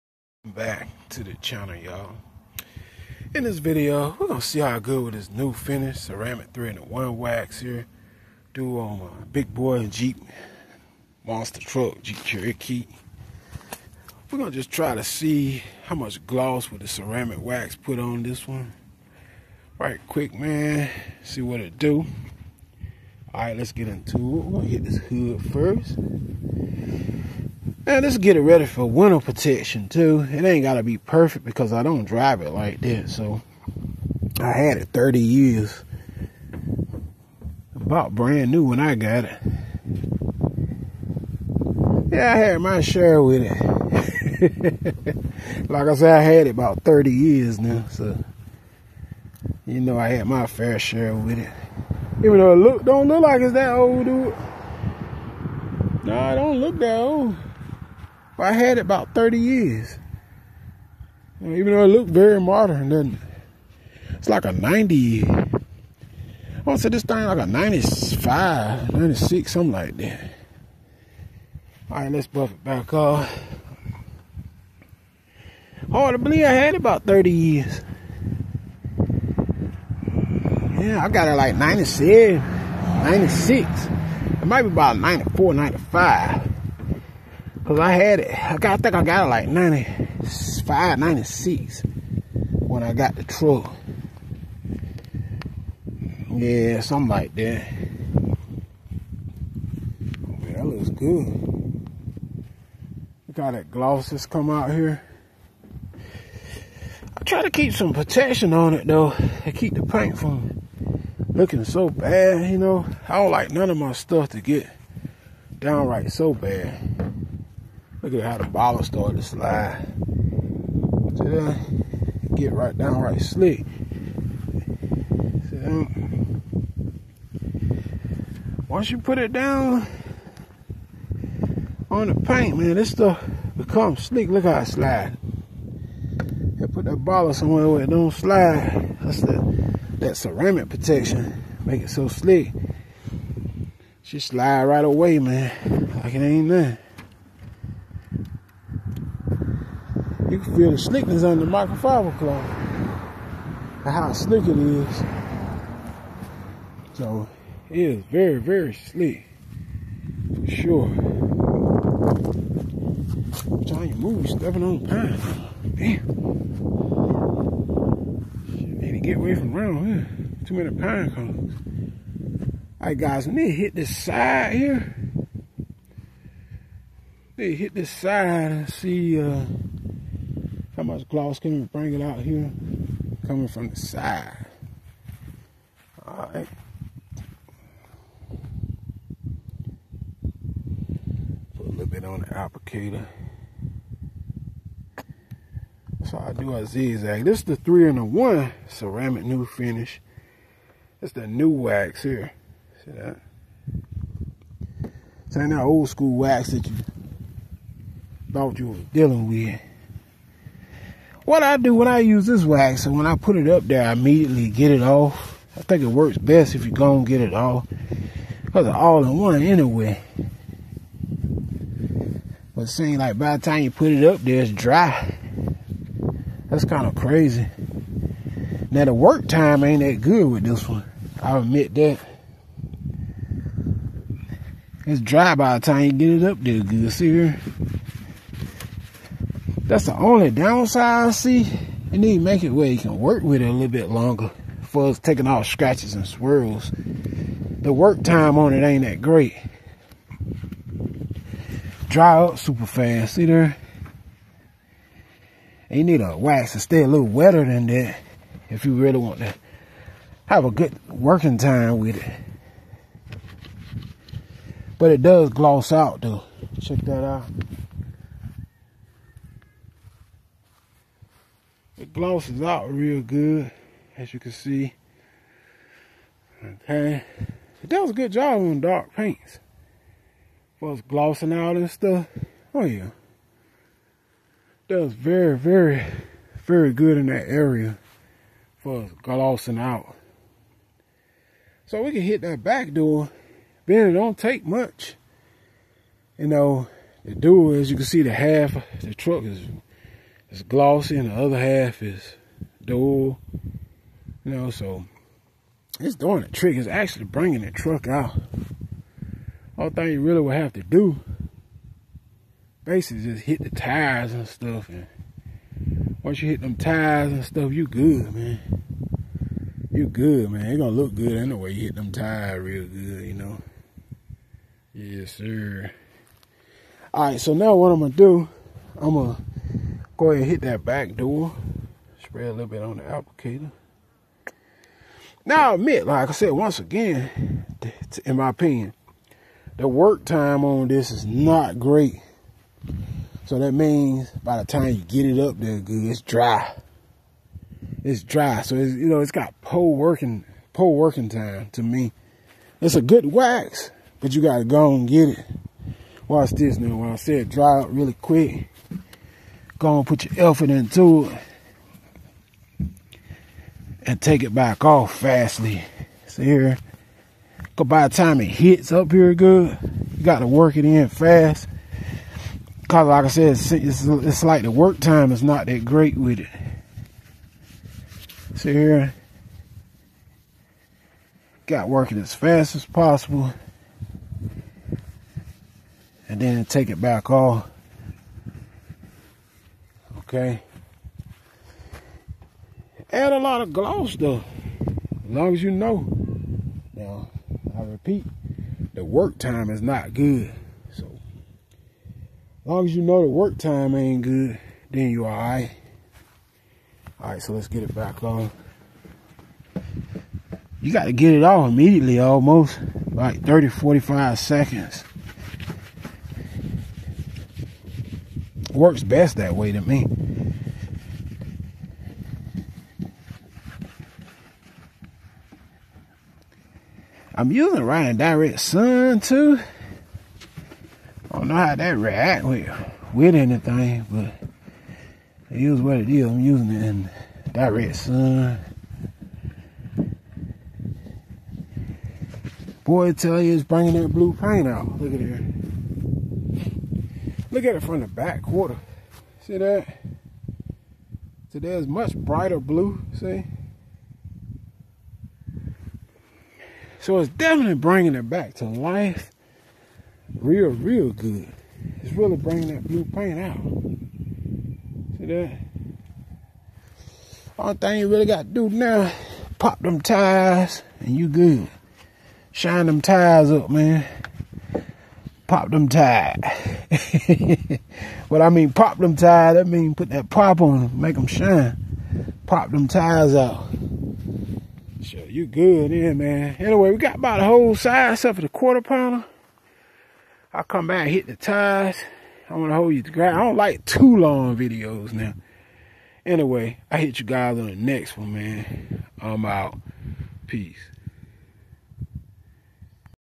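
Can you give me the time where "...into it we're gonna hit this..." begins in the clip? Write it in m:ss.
0:23.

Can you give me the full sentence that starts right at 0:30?
It ain't gotta be perfect because I don't drive it like that.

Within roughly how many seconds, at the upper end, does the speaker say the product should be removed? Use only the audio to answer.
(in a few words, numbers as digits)
45 seconds.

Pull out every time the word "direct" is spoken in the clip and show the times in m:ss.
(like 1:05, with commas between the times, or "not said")
7:07, 7:17.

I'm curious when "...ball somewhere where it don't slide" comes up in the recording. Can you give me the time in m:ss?
2:16.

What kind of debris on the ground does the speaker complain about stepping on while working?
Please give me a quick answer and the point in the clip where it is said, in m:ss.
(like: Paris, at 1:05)
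Pine cones, at 2:50.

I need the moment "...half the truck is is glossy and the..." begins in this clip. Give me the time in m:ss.
4:58.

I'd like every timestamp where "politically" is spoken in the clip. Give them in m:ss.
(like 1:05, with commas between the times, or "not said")
not said.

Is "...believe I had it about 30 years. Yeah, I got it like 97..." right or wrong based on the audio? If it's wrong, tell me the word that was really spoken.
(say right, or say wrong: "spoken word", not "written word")
right.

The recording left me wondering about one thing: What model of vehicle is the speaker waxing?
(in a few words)
Jeep Cherokee.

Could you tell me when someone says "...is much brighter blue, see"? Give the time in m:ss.
7:31.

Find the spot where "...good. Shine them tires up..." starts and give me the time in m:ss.
7:51.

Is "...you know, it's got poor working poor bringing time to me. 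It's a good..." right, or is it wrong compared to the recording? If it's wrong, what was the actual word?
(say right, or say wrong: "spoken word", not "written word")
wrong: "working", not "bringing".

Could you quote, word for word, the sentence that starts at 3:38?
Because it's all in one anyway.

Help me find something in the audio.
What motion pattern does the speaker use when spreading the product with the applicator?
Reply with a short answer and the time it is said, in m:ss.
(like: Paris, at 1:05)
Zigzag, at 3:16.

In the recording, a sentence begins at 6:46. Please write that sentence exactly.
Alright, so let's get it back on.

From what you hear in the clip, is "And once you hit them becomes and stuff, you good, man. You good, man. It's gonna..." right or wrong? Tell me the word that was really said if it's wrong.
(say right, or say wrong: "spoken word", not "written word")
wrong: "tires", not "becomes".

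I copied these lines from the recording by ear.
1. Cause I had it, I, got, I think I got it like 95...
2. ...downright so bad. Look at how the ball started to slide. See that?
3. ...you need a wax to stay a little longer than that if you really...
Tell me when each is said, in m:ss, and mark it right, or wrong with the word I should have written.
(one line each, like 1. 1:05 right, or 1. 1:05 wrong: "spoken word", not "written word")
1. 1:27 right
2. 1:55 right
3. 4:15 wrong: "wetter", not "longer".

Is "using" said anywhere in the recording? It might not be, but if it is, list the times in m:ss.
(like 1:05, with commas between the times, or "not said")
7:07, 7:16.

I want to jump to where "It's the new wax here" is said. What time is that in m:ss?
3:21.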